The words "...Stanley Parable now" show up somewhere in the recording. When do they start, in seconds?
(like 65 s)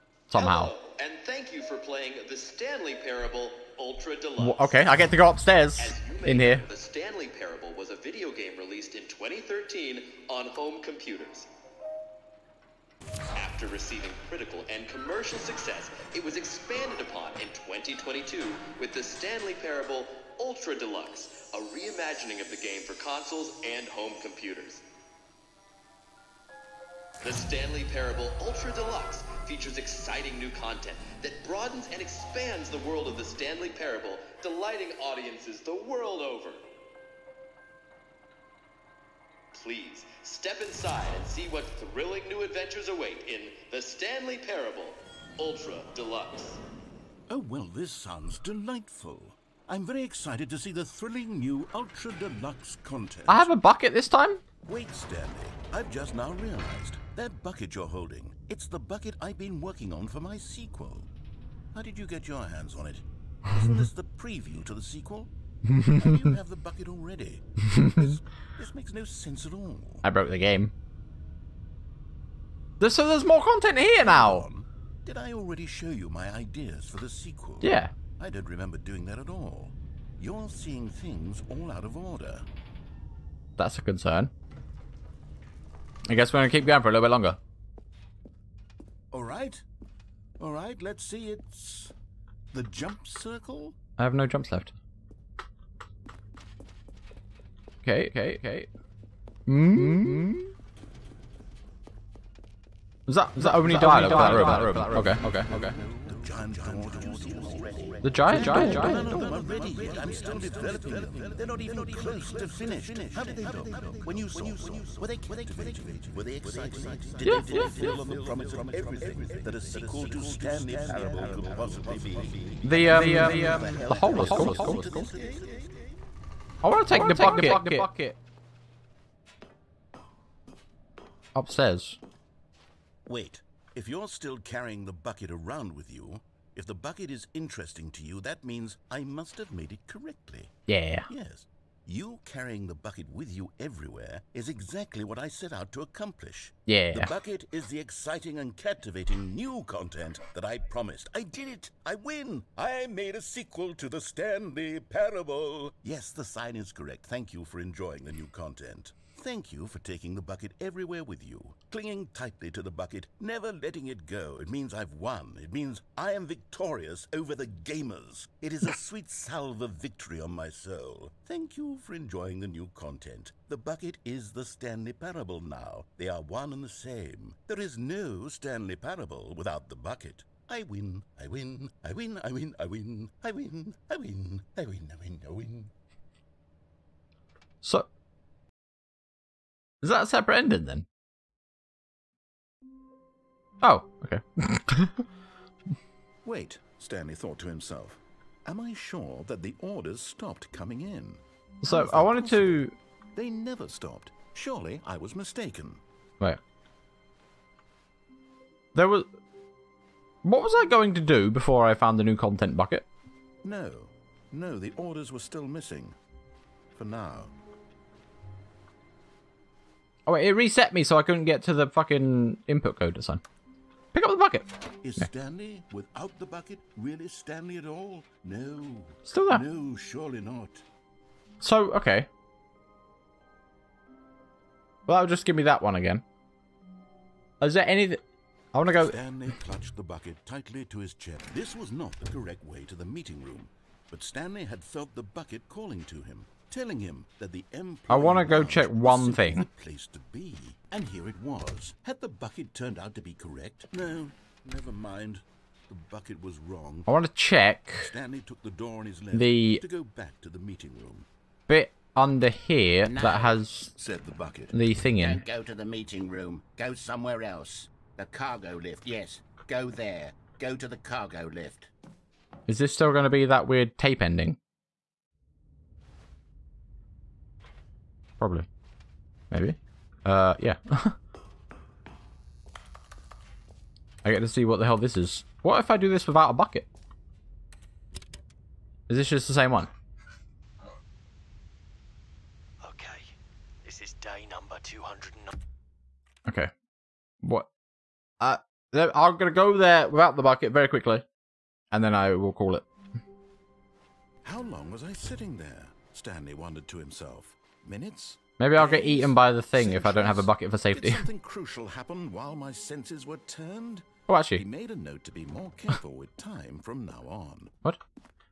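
174 s.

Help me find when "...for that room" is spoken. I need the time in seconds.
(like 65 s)
104 s.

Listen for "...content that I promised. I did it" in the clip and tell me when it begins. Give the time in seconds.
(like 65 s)
149 s.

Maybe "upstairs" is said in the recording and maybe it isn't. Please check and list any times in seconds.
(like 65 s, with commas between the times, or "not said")
5 s, 131 s.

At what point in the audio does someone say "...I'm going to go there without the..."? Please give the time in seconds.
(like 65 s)
298 s.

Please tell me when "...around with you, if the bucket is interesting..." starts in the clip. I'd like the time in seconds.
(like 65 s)
135 s.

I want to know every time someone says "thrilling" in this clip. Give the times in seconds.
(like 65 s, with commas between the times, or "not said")
41 s, 50 s.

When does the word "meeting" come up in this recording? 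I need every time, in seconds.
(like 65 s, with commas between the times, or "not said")
242 s, 260 s, 265 s.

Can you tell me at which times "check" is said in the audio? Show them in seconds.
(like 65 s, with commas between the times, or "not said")
248 s, 257 s.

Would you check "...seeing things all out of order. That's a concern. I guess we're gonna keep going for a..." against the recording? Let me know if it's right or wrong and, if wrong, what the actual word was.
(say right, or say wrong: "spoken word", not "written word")
right.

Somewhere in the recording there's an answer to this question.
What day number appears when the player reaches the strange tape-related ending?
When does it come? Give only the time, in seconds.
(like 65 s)
293 s.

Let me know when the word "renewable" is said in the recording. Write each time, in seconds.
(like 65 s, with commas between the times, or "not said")
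not said.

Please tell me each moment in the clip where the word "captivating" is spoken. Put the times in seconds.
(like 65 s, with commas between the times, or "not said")
115 s, 148 s.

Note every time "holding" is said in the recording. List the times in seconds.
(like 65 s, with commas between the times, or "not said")
57 s.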